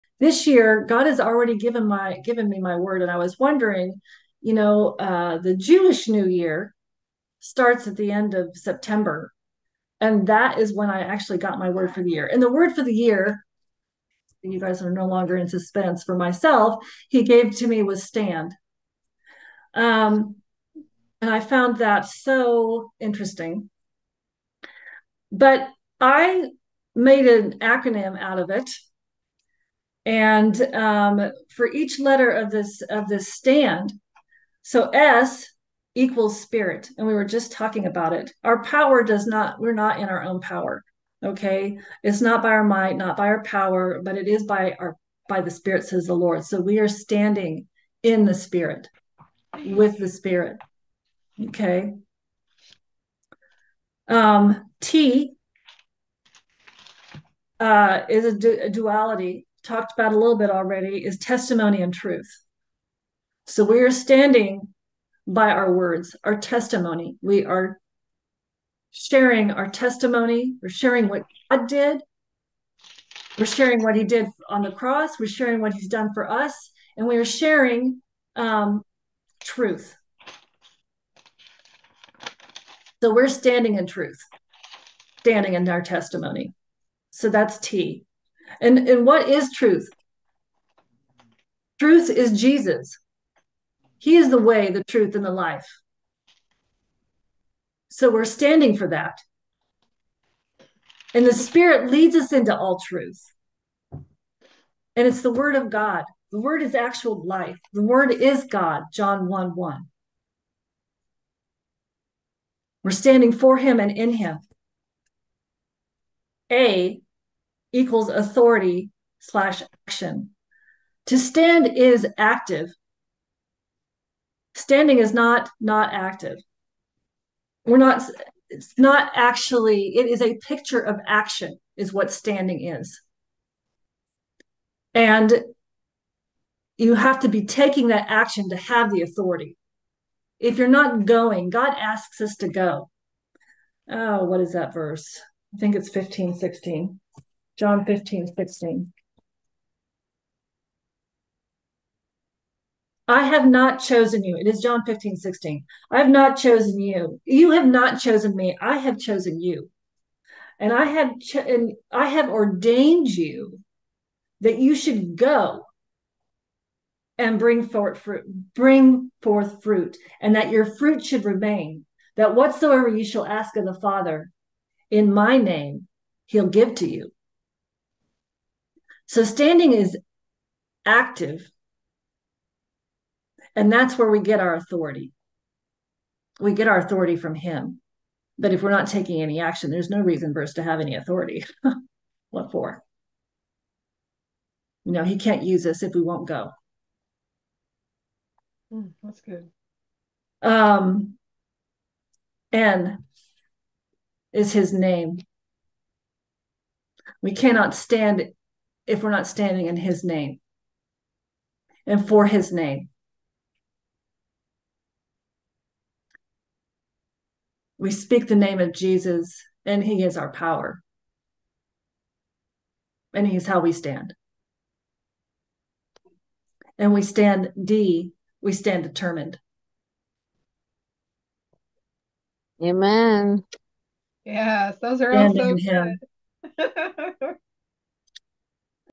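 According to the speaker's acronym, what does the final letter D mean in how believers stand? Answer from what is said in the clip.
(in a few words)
Determined.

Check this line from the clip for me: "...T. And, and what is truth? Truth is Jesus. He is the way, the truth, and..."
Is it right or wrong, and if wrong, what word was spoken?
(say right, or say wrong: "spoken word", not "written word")
right.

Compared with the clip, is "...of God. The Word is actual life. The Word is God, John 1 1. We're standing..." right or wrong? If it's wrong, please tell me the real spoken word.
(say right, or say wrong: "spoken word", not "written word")
right.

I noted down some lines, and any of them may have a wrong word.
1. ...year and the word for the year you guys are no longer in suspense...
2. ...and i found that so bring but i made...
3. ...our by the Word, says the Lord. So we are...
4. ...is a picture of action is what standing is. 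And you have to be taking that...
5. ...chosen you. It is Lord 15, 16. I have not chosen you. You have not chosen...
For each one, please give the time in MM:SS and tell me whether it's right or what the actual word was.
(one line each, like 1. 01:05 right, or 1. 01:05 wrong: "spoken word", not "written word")
1. 00:12 right
2. 00:21 wrong: "interesting", not "bring"
3. 00:44 wrong: "Spirit", not "Word"
4. 02:10 right
5. 02:33 wrong: "John", not "Lord".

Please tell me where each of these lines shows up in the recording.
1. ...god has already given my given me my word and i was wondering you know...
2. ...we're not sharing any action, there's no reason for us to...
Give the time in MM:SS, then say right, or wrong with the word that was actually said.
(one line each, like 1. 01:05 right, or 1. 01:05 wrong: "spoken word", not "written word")
1. 00:00 right
2. 03:08 wrong: "taking", not "sharing".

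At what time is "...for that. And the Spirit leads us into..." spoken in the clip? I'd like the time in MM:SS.
01:38.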